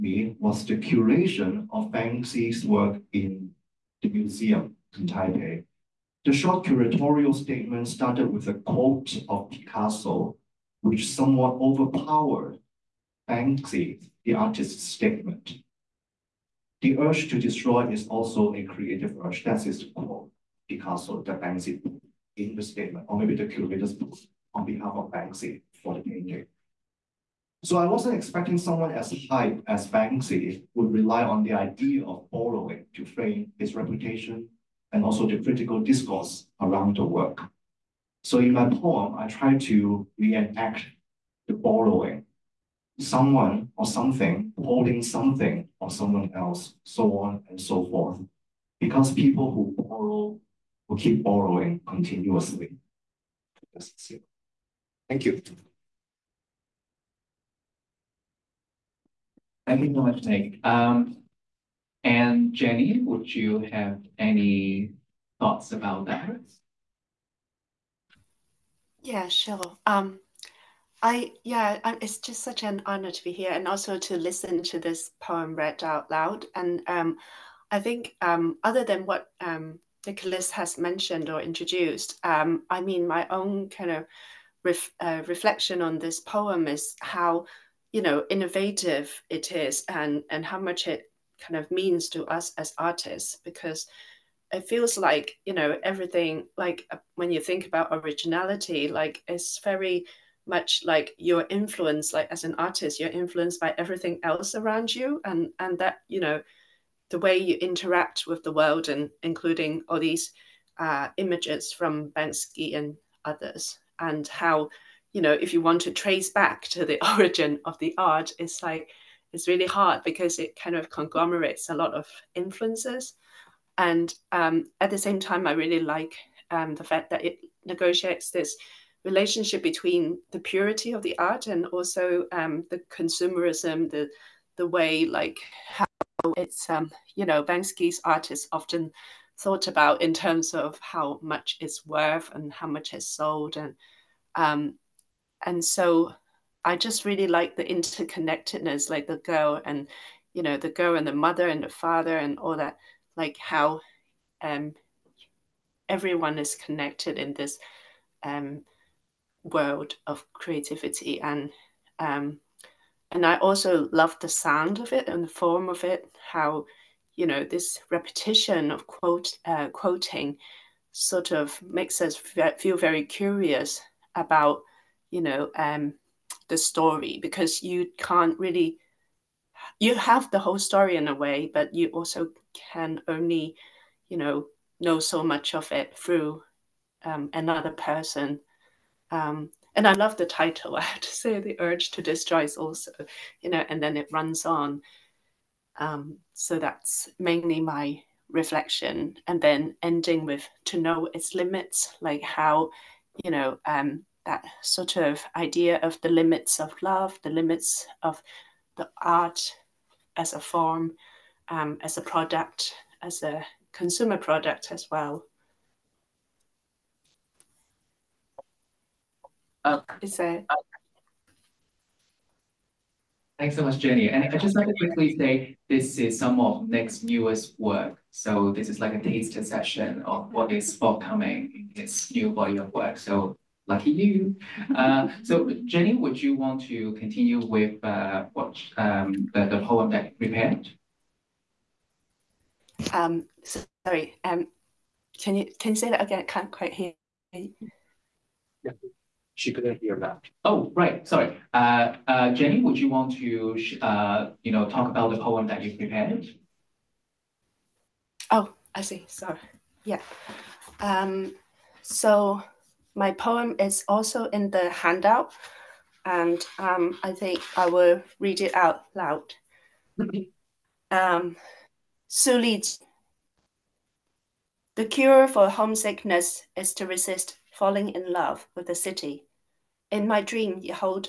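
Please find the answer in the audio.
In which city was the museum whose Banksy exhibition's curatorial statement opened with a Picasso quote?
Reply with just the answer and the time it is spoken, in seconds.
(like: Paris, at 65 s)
Taipei, at 5 s.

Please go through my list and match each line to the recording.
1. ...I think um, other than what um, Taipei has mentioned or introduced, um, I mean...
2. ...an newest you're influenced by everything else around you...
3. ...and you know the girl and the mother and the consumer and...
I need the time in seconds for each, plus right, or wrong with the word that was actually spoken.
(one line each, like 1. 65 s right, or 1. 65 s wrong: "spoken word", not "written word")
1. 77 s wrong: "Nicholas", not "Taipei"
2. 102 s wrong: "artist", not "newest"
3. 149 s wrong: "father", not "consumer".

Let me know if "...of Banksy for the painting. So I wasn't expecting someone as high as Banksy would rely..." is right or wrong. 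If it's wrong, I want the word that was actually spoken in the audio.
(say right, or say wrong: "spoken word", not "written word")
right.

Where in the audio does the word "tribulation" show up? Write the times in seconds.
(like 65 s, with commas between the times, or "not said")
not said.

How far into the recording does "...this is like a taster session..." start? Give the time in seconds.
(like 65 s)
228 s.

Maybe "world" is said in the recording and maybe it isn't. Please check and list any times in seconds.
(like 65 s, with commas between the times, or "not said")
108 s, 159 s.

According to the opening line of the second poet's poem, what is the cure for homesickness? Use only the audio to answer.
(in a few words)
to resist falling in love.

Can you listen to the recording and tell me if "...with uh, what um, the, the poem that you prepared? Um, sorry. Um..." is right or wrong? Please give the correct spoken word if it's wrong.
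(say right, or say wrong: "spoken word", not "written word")
right.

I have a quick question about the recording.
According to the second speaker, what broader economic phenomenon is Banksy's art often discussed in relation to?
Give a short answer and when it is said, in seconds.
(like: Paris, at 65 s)
consumerism, at 132 s.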